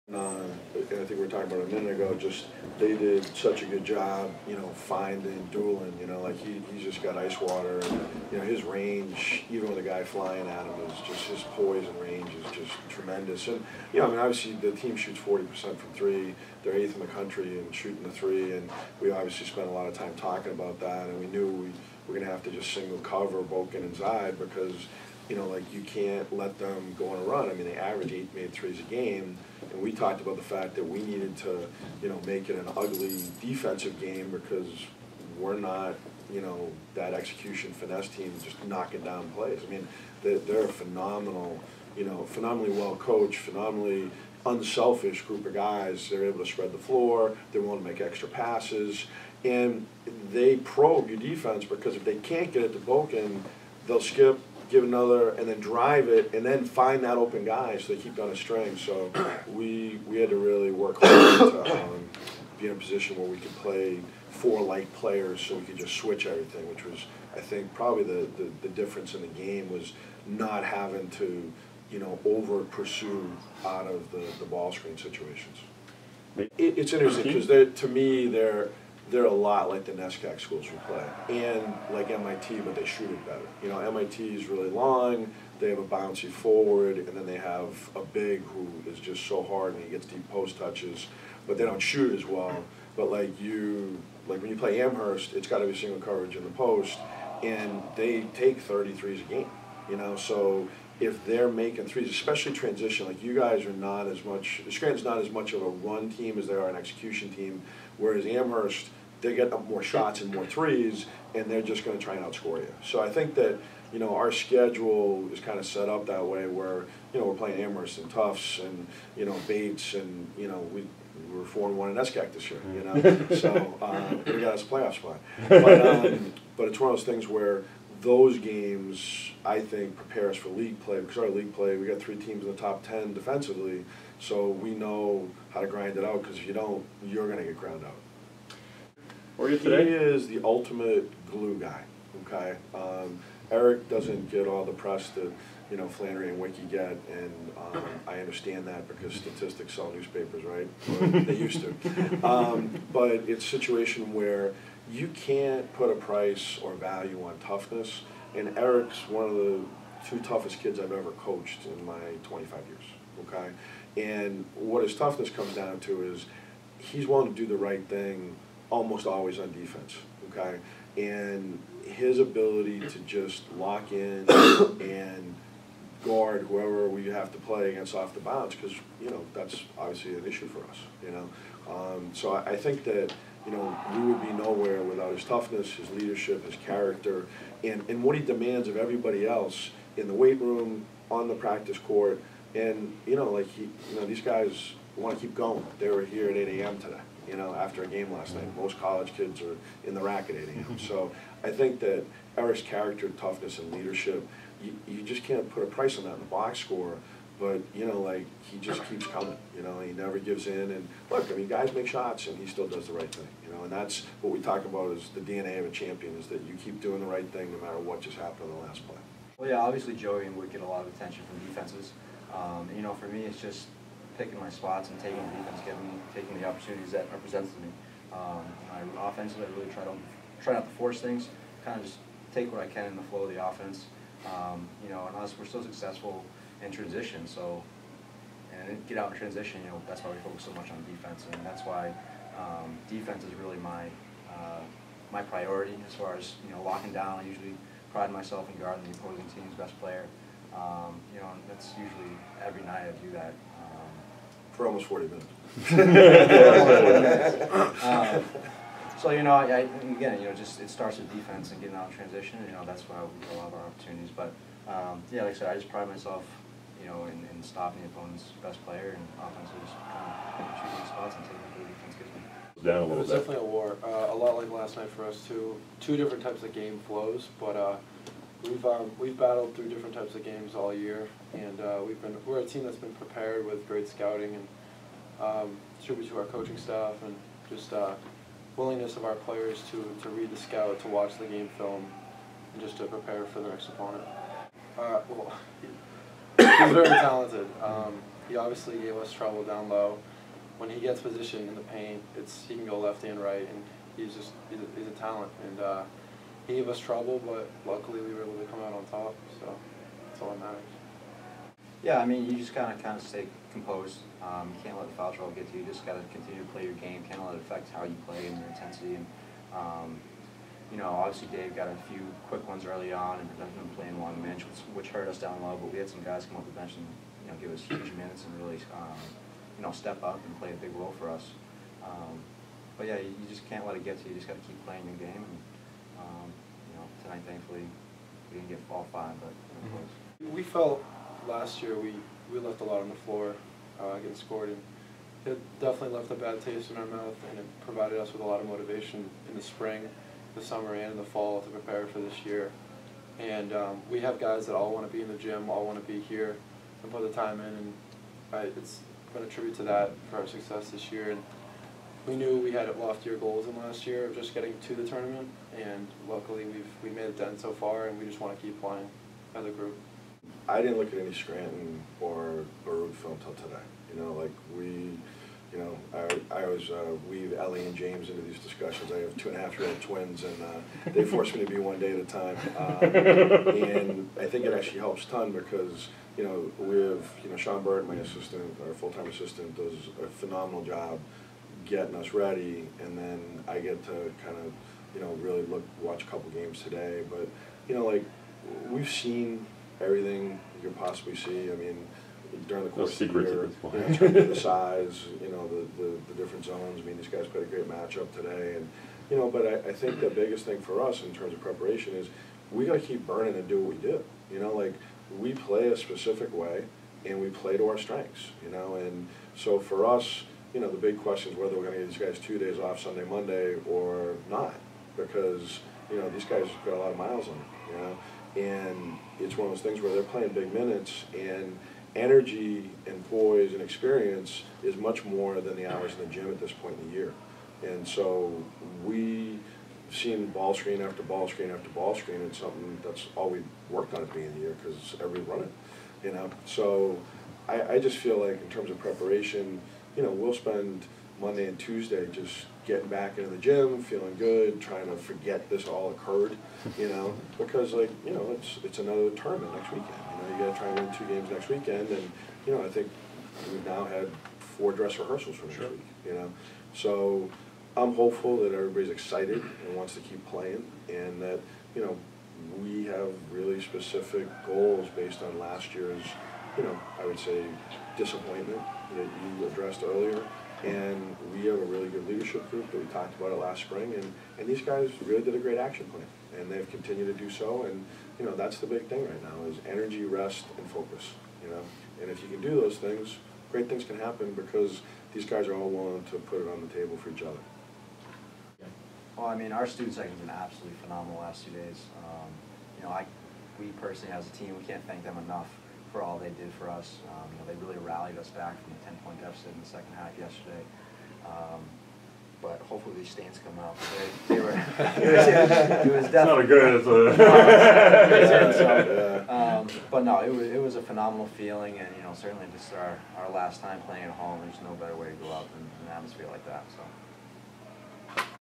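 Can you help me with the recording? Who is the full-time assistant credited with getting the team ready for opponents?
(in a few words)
Sean Bird.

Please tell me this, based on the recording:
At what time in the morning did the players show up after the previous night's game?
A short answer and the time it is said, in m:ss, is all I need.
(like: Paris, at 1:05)
8 a.m., at 3:16.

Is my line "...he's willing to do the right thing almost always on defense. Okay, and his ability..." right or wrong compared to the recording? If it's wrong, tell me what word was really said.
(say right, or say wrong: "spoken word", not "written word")
right.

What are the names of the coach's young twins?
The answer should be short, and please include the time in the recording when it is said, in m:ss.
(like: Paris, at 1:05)
Ellie and James, at 6:17.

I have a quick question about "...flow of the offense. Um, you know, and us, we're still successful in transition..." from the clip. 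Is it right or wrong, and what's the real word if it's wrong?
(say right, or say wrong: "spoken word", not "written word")
right.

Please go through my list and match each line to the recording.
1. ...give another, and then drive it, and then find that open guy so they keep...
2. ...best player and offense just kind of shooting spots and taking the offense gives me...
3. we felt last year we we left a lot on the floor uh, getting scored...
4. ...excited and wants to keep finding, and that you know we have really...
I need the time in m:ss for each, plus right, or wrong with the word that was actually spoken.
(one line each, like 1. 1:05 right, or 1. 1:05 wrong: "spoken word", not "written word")
1. 0:54 right
2. 4:28 wrong: "defense", not "offense"
3. 5:40 right
4. 7:48 wrong: "playing", not "finding".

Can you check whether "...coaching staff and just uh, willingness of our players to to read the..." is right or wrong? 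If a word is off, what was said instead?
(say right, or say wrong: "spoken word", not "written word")
right.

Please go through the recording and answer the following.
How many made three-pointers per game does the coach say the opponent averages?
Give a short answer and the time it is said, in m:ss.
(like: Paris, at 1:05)
8, at 0:28.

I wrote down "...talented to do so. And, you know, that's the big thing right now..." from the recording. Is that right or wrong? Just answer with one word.
wrong.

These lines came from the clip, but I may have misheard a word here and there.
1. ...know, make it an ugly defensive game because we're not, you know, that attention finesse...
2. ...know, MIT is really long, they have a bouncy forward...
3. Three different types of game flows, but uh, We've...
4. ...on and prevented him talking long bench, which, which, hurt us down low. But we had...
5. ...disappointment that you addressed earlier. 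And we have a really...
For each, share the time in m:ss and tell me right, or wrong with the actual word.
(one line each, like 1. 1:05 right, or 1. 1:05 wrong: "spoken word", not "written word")
1. 0:32 wrong: "execution", not "attention"
2. 1:23 right
3. 4:35 wrong: "Two", not "Three"
4. 5:22 wrong: "playing", not "talking"
5. 7:57 right.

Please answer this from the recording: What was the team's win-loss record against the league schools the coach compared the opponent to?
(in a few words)
4-1.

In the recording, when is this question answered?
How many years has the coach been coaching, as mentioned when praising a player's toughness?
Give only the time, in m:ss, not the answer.
2:42.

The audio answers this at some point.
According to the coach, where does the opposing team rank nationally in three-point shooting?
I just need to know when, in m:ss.
0:16.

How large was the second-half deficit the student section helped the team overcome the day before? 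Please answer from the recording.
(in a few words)
10 points.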